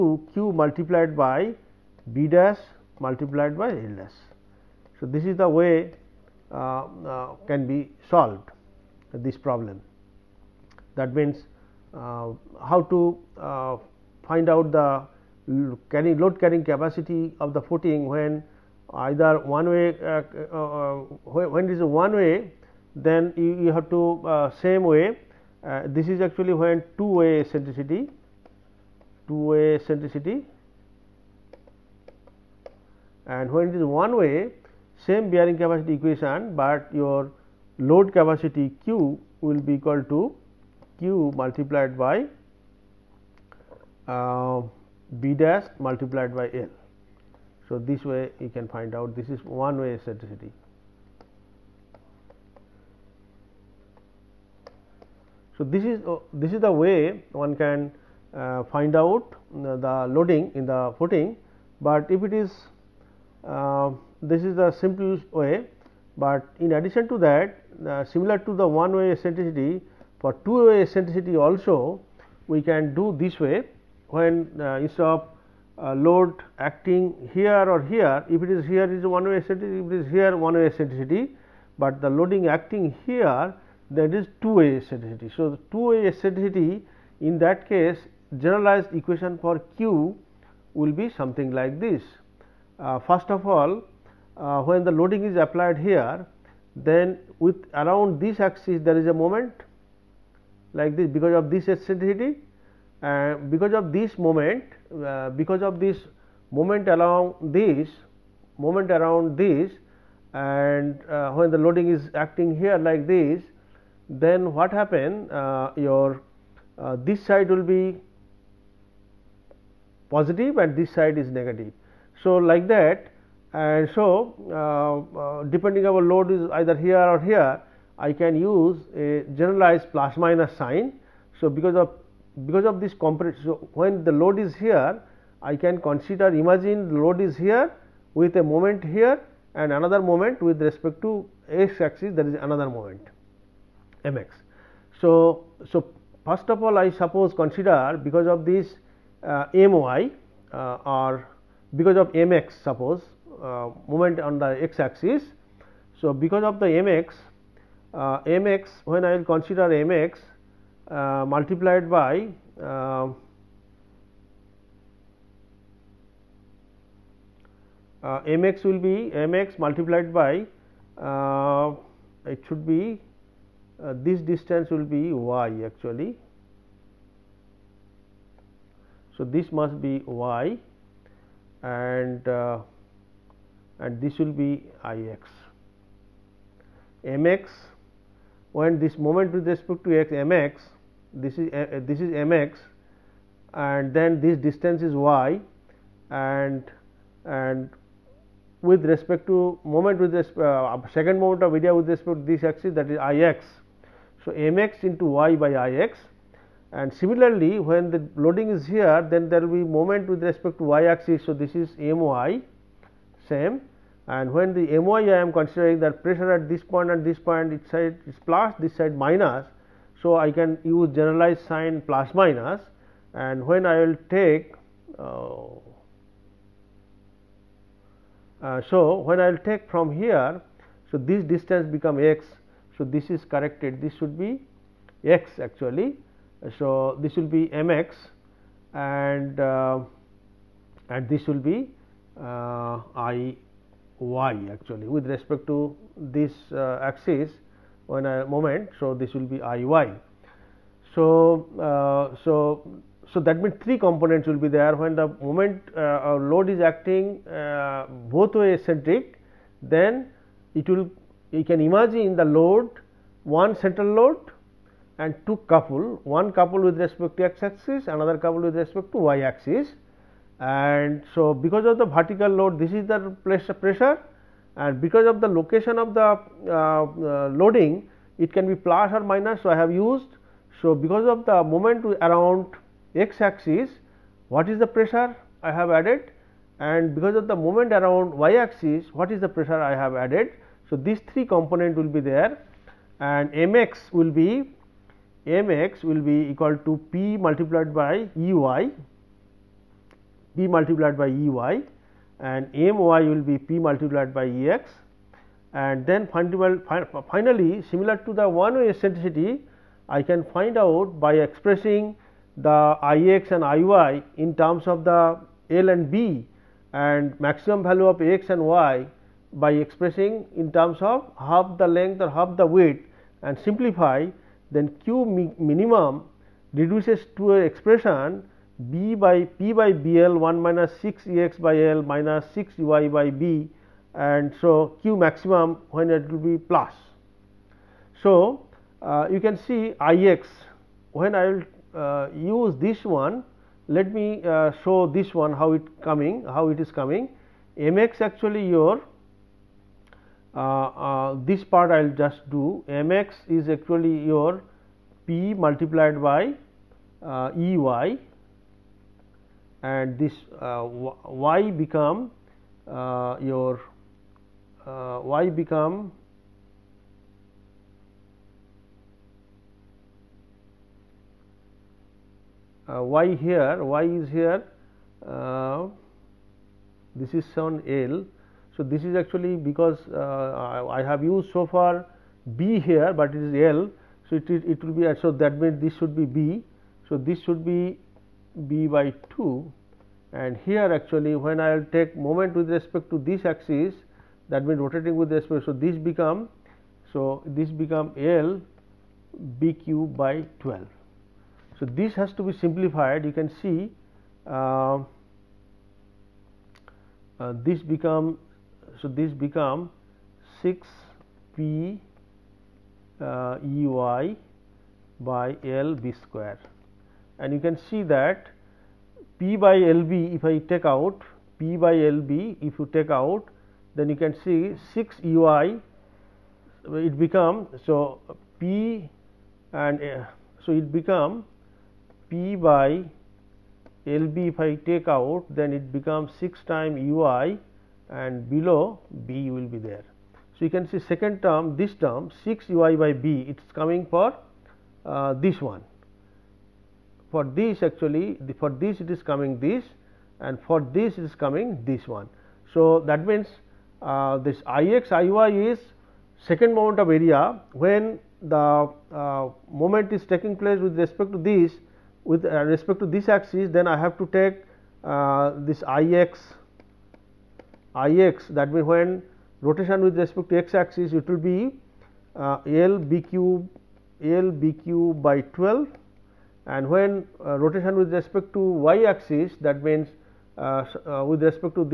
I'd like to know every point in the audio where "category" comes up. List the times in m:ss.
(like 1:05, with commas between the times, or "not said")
not said.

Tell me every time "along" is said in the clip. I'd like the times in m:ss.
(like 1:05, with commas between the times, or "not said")
1:46.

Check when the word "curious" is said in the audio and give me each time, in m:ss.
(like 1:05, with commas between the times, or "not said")
not said.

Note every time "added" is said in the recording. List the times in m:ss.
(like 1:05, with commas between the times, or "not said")
4:45, 4:49.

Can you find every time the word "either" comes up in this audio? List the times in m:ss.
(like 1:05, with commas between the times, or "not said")
0:19, 2:06.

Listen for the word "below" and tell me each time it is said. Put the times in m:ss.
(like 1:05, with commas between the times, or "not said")
7:18.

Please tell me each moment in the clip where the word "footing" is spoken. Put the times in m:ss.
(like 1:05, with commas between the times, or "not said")
0:17, 1:00.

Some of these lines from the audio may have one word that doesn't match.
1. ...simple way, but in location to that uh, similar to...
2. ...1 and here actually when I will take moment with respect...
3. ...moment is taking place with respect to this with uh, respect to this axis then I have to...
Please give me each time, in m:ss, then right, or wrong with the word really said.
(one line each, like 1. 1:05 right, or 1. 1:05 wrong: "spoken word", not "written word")
1. 1:04 wrong: "addition", not "location"
2. 6:29 wrong: "2", not "1"
3. 7:39 right.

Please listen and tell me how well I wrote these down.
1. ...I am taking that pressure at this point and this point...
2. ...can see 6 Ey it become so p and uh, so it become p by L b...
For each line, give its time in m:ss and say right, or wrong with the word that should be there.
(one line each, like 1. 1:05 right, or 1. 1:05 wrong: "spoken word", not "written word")
1. 3:35 wrong: "considering", not "taking"
2. 7:03 right.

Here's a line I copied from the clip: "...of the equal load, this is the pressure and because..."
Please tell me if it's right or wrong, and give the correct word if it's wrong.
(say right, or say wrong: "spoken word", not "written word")
wrong: "vertical", not "equal".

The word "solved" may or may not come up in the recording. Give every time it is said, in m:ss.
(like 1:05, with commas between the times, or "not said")
0:08.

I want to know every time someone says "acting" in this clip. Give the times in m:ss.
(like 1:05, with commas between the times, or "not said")
1:16, 1:22, 1:52, 4:16.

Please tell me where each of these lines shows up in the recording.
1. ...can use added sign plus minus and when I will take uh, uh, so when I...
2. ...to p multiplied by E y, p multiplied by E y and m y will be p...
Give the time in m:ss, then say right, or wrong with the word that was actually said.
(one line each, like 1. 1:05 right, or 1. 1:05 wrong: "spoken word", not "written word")
1. 3:40 wrong: "generalized", not "added"
2. 4:56 right.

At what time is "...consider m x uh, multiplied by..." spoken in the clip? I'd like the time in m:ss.
2:39.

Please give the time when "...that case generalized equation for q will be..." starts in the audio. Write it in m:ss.
1:27.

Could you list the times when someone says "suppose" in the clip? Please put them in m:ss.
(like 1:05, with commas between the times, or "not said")
2:26, 2:32.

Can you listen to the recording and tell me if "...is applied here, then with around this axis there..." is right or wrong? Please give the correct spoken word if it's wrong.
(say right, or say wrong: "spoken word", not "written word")
right.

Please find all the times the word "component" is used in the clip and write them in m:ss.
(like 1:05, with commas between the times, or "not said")
2:12, 4:13, 4:51.